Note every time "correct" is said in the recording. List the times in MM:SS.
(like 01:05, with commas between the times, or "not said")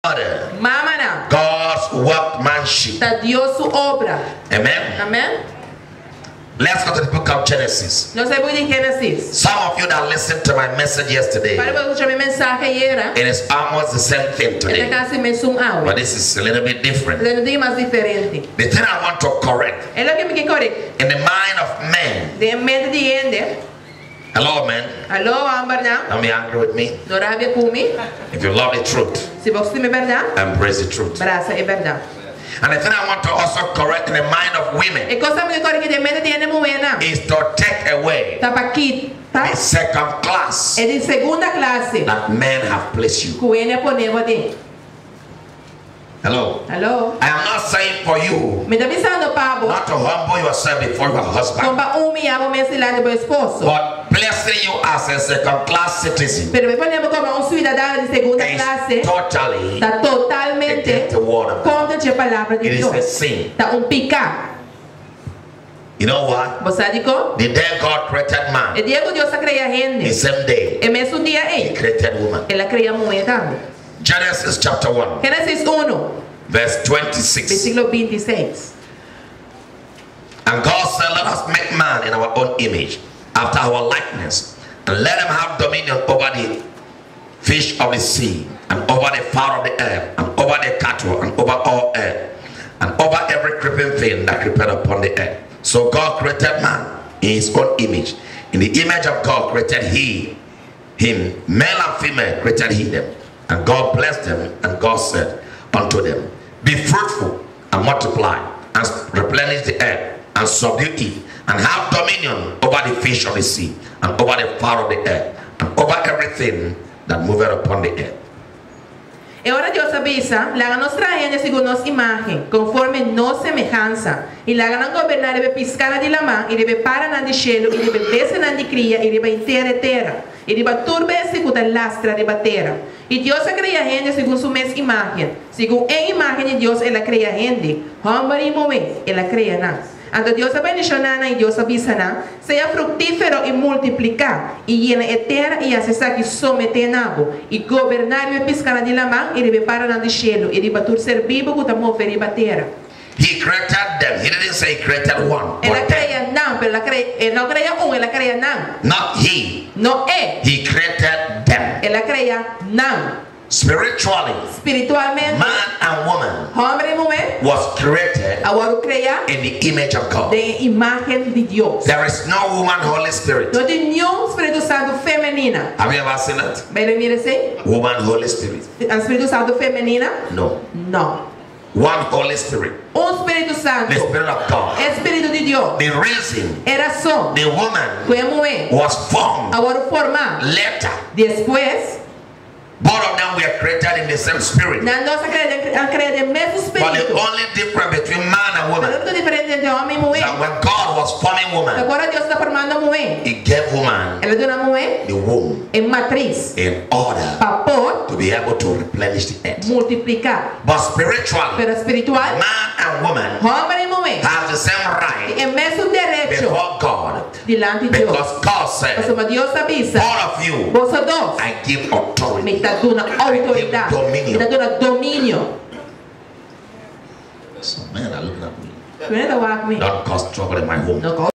00:19, 00:33.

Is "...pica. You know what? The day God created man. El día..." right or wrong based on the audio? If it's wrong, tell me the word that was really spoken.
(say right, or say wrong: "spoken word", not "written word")
right.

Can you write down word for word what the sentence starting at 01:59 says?
E ahora Dios avisa, La nos traen según nos imagen, conforme nos semejanza.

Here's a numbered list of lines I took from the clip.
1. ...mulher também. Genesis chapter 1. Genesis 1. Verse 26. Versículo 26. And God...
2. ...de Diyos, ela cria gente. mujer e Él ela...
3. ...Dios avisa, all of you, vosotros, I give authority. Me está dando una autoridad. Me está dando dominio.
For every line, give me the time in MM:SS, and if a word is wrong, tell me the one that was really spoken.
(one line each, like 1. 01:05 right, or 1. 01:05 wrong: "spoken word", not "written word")
1. 01:12 right
2. 02:16 wrong: "Deus", not "Diyos"
3. 03:39 right.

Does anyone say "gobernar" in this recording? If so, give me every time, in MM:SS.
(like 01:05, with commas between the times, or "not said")
02:04, 02:27.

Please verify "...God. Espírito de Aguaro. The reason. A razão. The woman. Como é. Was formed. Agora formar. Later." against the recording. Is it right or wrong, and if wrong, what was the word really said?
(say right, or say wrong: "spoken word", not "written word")
wrong: "Deus", not "Aguaro".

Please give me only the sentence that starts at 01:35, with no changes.
So God created man in his own image.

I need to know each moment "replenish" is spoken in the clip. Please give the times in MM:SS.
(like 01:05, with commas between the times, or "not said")
01:49, 03:28.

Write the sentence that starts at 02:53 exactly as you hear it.
No tem nenhum Espírito Santo feminina.